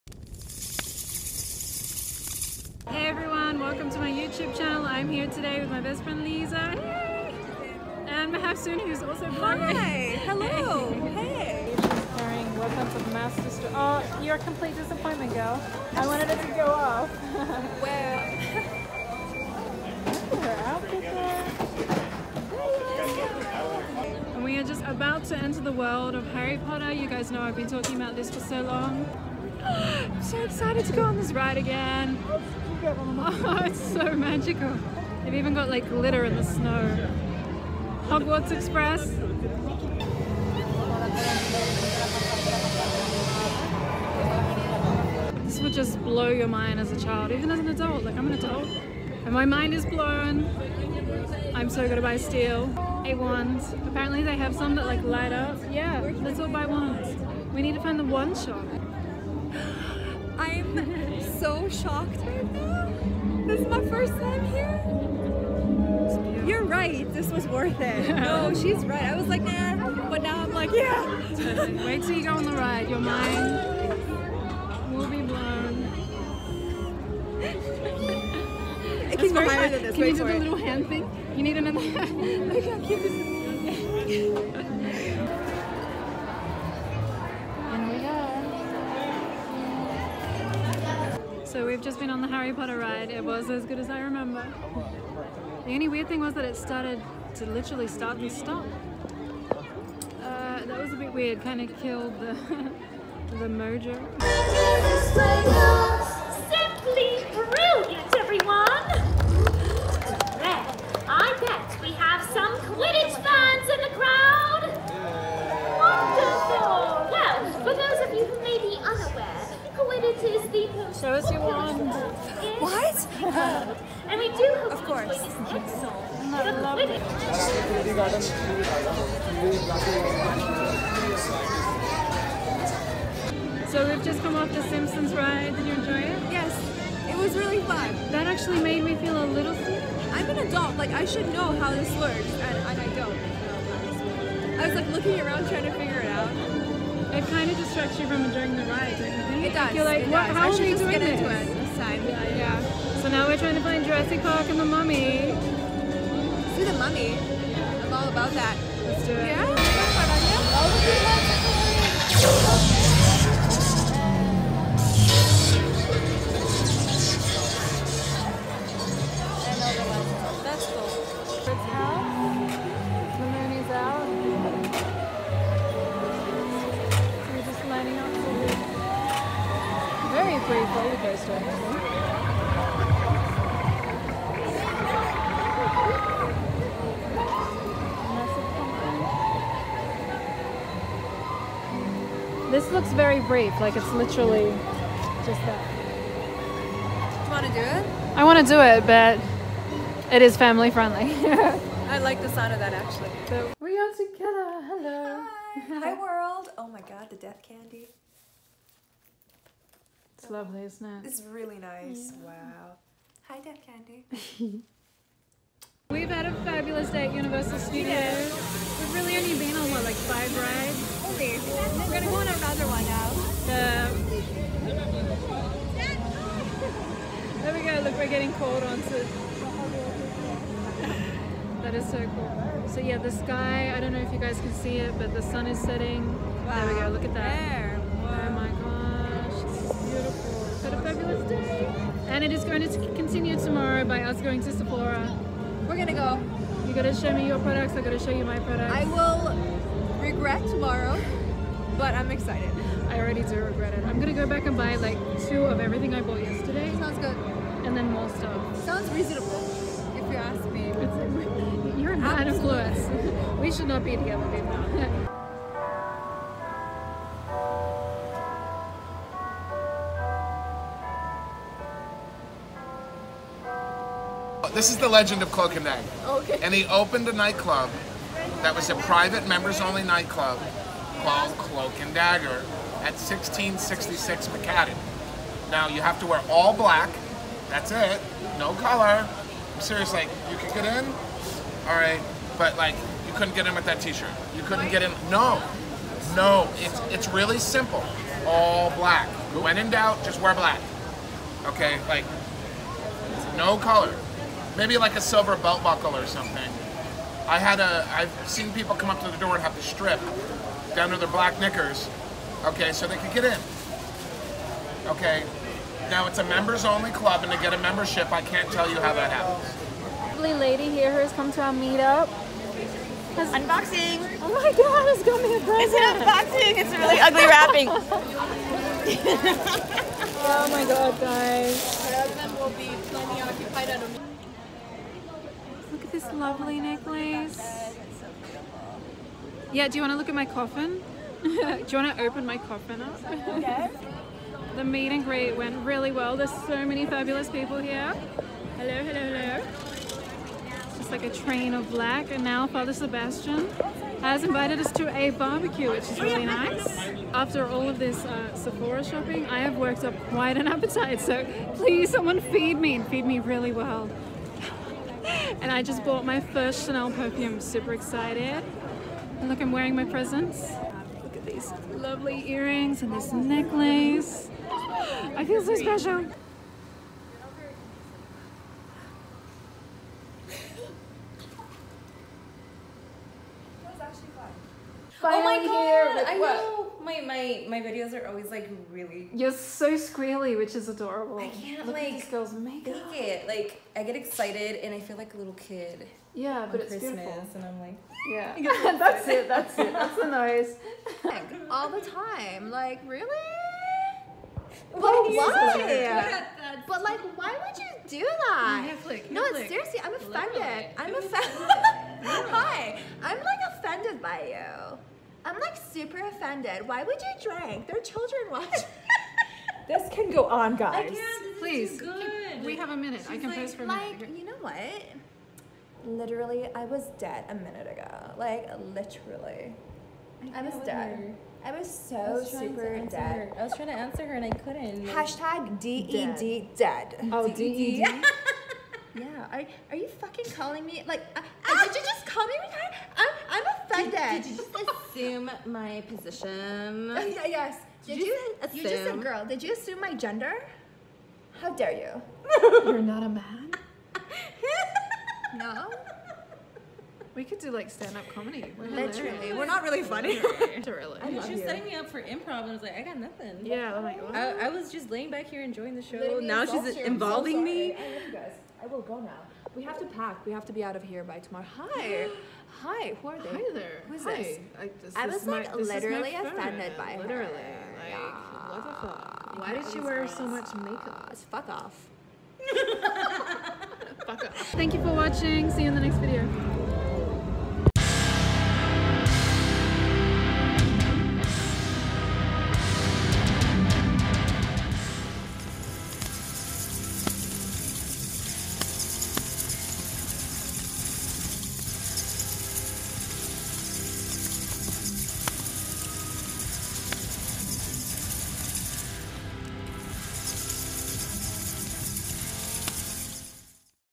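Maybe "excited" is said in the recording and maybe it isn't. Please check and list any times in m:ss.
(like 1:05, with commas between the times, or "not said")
0:30, 4:12, 6:07, 6:33.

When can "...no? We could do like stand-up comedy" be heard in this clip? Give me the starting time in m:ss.
7:35.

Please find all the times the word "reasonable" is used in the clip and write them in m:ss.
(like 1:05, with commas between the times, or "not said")
4:18.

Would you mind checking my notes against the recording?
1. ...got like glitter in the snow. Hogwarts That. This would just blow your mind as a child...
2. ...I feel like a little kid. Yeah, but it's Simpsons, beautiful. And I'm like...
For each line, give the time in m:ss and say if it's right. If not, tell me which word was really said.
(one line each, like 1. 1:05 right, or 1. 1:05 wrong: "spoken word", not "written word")
1. 0:35 wrong: "Express", not "That"
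2. 6:34 wrong: "Christmas", not "Simpsons".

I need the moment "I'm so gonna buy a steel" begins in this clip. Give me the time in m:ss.
0:51.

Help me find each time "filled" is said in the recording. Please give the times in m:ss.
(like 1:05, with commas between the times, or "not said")
not said.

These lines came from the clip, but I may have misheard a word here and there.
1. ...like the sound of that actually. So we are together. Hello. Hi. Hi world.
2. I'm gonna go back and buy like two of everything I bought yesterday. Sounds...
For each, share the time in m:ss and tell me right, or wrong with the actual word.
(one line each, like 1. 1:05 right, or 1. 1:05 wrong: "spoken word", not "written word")
1. 3:21 right
2. 4:13 right.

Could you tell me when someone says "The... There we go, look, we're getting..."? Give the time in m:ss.
3:43.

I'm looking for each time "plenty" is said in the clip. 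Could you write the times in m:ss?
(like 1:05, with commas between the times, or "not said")
5:32.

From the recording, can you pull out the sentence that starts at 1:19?
Can Wait you do the little hand thing?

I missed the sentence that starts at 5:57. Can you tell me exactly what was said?
After all of this uh, Sephora shopping, I have worked up quite an appetite.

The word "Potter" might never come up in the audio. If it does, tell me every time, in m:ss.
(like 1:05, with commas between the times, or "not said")
0:26, 1:32.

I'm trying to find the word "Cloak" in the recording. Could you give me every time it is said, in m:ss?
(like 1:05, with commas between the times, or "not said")
4:35, 4:41.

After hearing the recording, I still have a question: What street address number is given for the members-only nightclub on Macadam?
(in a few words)
1666.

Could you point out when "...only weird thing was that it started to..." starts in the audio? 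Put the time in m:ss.
1:35.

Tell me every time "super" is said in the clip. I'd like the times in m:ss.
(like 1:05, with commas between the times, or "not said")
6:07, 6:55, 7:12.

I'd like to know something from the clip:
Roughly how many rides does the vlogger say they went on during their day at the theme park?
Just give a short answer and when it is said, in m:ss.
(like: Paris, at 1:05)
5, at 3:40.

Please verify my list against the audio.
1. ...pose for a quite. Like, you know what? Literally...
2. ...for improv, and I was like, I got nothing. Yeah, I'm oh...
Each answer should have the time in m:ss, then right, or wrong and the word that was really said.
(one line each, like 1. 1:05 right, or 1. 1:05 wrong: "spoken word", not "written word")
1. 7:03 wrong: "minute", not "quite"
2. 7:41 right.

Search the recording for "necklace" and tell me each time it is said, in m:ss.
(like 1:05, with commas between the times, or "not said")
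5:36, 6:13.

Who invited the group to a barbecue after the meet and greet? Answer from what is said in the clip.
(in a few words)
Father Sebastian.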